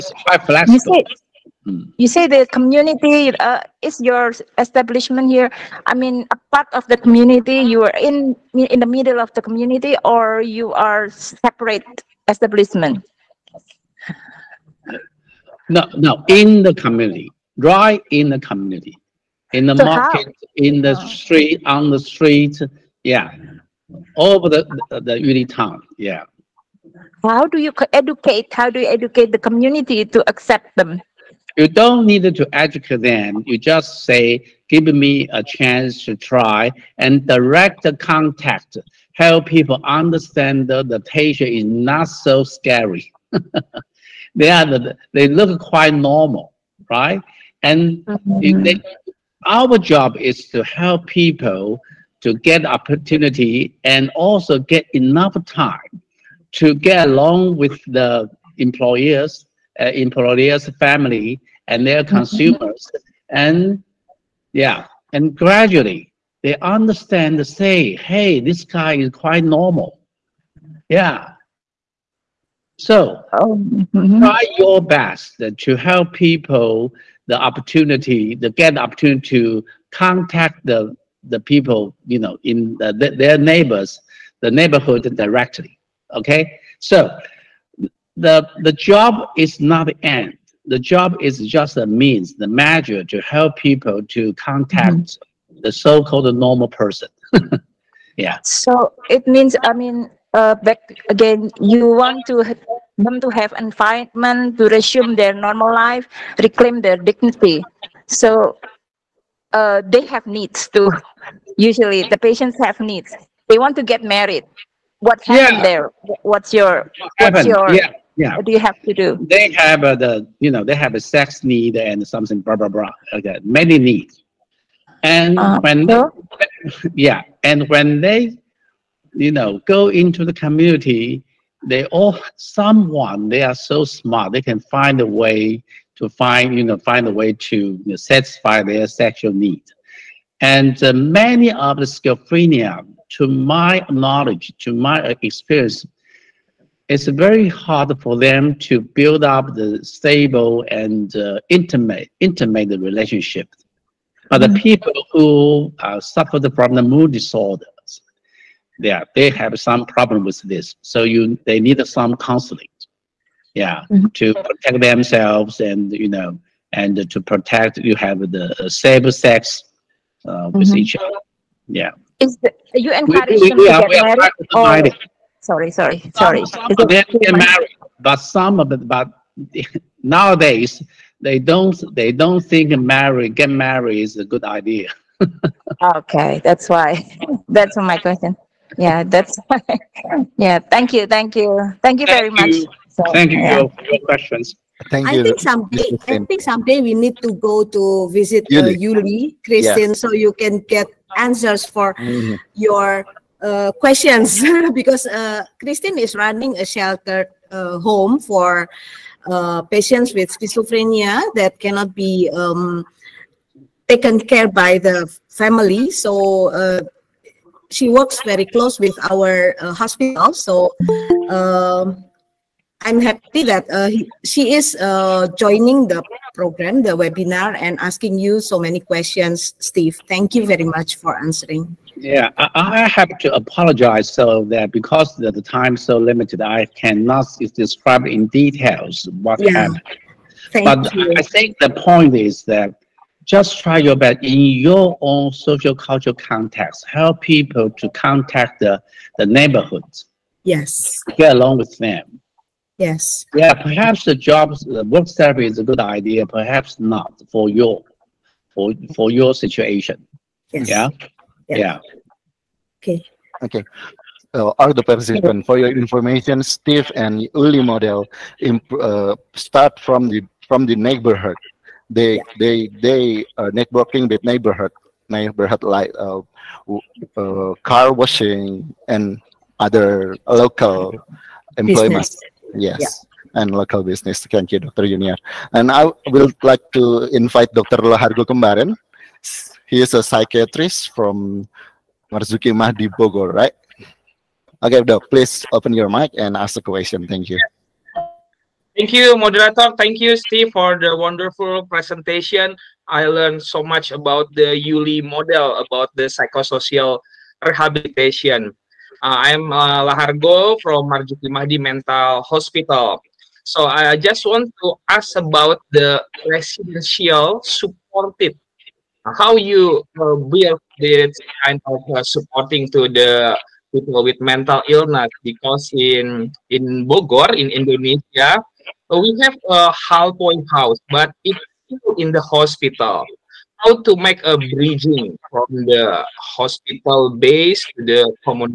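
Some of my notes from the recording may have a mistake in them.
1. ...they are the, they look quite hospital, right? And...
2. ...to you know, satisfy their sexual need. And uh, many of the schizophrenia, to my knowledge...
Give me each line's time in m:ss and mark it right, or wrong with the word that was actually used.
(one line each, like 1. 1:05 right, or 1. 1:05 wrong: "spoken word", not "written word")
1. 0:44 wrong: "normal", not "hospital"
2. 2:17 right.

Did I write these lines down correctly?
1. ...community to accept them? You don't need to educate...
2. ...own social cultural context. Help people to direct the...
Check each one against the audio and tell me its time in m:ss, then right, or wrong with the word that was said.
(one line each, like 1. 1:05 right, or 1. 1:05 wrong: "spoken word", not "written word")
1. 0:29 right
2. 4:05 wrong: "contact", not "direct".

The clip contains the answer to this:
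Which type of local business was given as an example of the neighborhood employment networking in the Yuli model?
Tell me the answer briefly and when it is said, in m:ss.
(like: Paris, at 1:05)
car washing, at 4:37.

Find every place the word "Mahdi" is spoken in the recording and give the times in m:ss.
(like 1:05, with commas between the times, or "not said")
4:52, 5:11.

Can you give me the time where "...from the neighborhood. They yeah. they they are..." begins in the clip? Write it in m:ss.
4:30.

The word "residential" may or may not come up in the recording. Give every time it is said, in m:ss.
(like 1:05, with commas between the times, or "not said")
5:16.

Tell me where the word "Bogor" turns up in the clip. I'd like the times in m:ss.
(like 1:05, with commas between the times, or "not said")
4:52, 5:26.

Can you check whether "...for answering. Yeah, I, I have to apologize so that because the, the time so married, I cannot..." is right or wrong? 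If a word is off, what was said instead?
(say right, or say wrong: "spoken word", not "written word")
wrong: "limited", not "married".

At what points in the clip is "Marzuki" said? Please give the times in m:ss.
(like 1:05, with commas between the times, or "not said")
4:52, 5:10.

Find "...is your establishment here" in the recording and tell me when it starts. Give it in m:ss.
0:03.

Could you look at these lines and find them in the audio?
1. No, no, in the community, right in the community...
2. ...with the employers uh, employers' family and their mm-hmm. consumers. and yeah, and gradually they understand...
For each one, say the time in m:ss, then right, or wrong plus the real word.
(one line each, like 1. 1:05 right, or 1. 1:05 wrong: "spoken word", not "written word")
1. 0:15 right
2. 0:57 right.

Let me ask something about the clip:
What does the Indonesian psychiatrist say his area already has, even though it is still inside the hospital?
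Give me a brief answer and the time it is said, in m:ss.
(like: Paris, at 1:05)
a point house, at 5:29.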